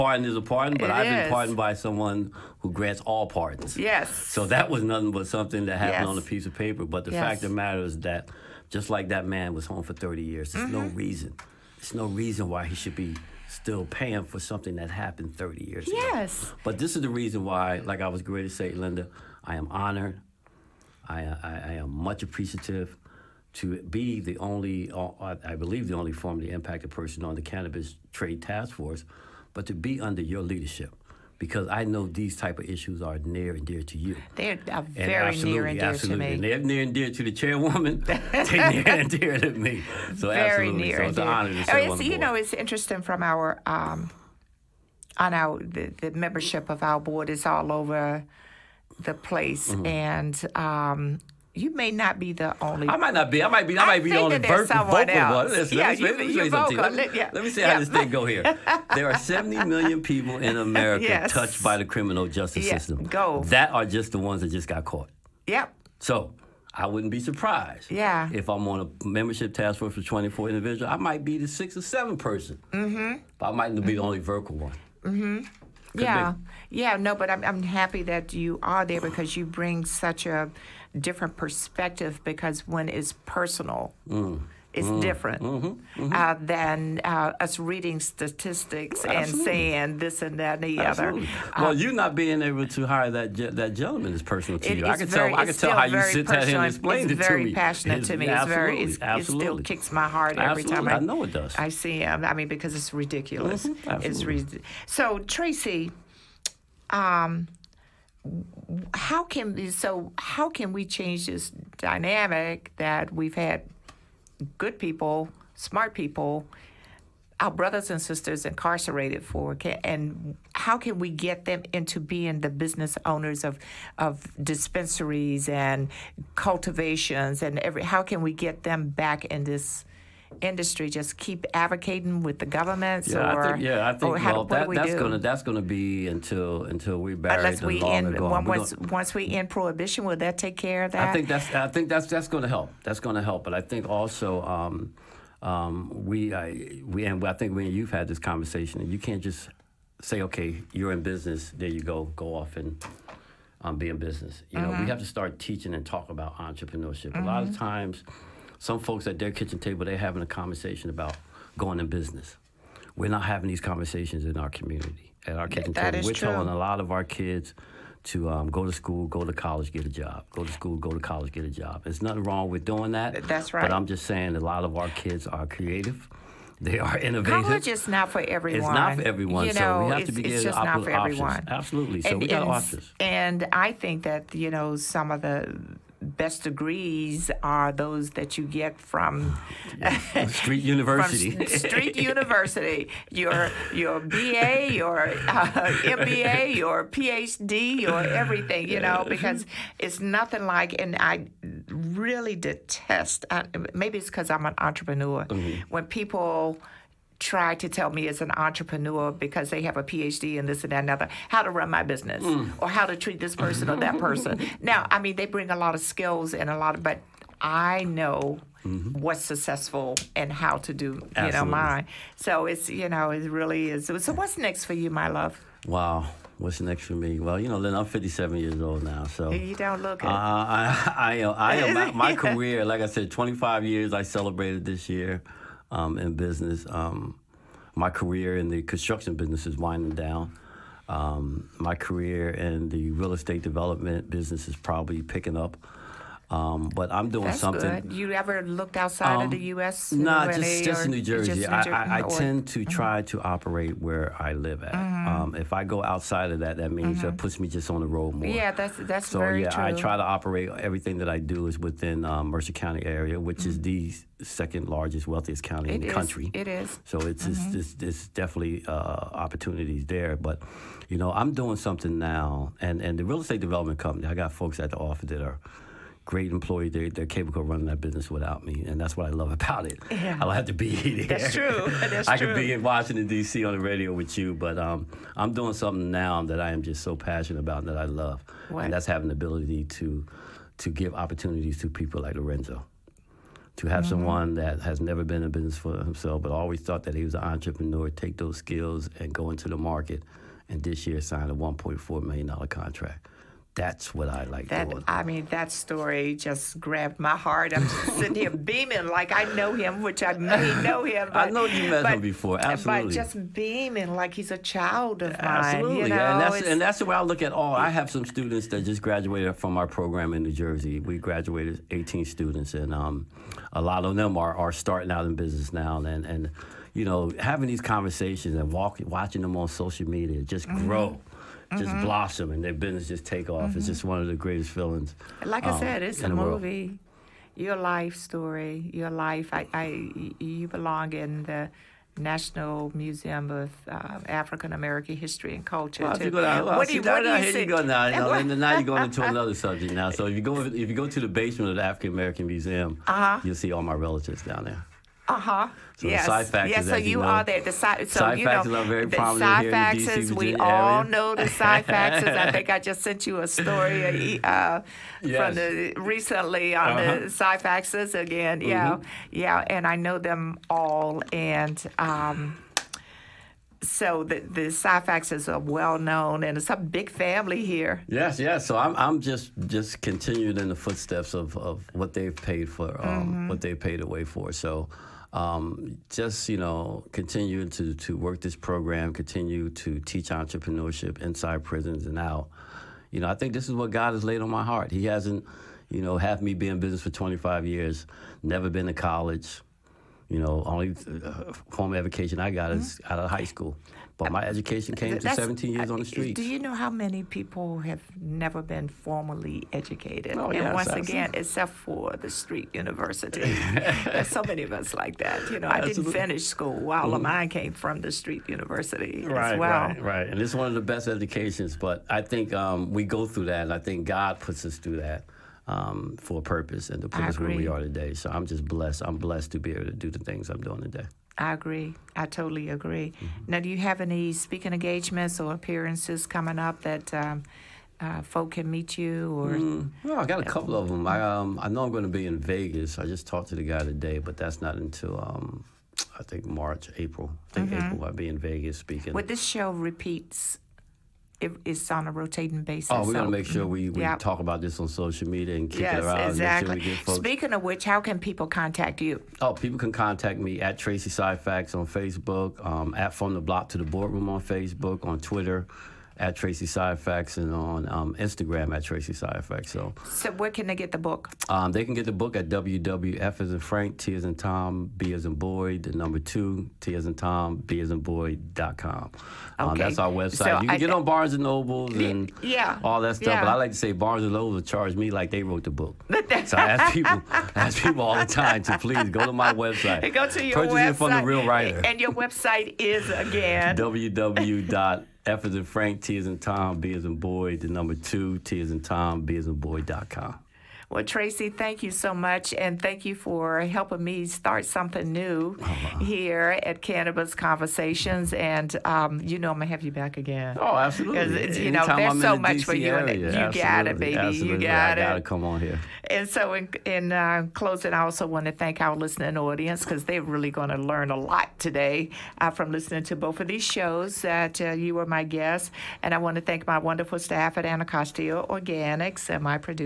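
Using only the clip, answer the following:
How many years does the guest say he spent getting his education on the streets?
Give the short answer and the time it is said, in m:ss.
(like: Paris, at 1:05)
17, at 6:45.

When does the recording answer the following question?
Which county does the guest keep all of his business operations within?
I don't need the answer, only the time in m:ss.
4:22.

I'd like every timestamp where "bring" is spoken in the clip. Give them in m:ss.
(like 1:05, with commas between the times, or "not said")
1:19, 3:35.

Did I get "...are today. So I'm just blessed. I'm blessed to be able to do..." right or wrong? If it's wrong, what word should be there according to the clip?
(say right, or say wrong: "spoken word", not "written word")
right.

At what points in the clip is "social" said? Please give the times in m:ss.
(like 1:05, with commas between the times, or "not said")
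5:29, 7:34.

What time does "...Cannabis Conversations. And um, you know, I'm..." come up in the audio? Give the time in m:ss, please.
8:26.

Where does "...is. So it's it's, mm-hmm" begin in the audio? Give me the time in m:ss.
4:26.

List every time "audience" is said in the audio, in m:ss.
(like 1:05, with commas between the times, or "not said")
8:39.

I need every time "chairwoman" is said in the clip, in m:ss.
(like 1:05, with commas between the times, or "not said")
0:37.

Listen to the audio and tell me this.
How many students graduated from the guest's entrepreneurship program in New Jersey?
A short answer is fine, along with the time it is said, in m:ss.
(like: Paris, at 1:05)
18, at 5:21.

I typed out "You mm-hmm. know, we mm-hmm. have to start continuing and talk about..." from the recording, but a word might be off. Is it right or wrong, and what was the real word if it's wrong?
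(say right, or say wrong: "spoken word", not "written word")
wrong: "teaching", not "continuing".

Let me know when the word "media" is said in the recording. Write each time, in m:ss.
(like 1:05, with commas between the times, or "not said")
5:29, 7:35.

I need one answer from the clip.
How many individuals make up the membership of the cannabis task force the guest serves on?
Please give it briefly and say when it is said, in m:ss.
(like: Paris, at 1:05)
24, at 1:10.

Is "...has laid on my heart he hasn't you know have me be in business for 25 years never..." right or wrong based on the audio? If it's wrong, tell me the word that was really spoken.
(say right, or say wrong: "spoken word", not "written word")
right.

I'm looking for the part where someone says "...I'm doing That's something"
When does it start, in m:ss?
4:06.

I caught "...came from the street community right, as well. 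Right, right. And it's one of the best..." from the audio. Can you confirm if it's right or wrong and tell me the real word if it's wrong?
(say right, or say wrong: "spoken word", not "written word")
wrong: "university", not "community".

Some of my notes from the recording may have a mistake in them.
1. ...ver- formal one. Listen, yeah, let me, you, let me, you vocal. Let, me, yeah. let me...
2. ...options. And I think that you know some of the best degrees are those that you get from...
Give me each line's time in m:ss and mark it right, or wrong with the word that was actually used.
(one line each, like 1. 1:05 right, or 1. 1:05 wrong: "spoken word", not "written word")
1. 0:54 wrong: "vocal", not "formal"
2. 3:02 right.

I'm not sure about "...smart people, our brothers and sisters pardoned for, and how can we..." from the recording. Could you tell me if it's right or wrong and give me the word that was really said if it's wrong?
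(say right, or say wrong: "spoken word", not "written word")
wrong: "incarcerated", not "pardoned".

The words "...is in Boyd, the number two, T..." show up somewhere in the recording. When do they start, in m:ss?
8:16.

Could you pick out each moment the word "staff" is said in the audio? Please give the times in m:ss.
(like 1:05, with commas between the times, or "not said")
8:46.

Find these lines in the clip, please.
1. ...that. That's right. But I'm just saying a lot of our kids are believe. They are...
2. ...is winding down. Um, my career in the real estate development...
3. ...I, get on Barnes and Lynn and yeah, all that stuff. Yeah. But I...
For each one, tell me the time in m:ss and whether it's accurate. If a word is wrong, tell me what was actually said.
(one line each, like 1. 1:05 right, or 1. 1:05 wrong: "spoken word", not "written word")
1. 2:52 wrong: "creative", not "believe"
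2. 3:59 right
3. 8:00 wrong: "Nobles", not "Lynn".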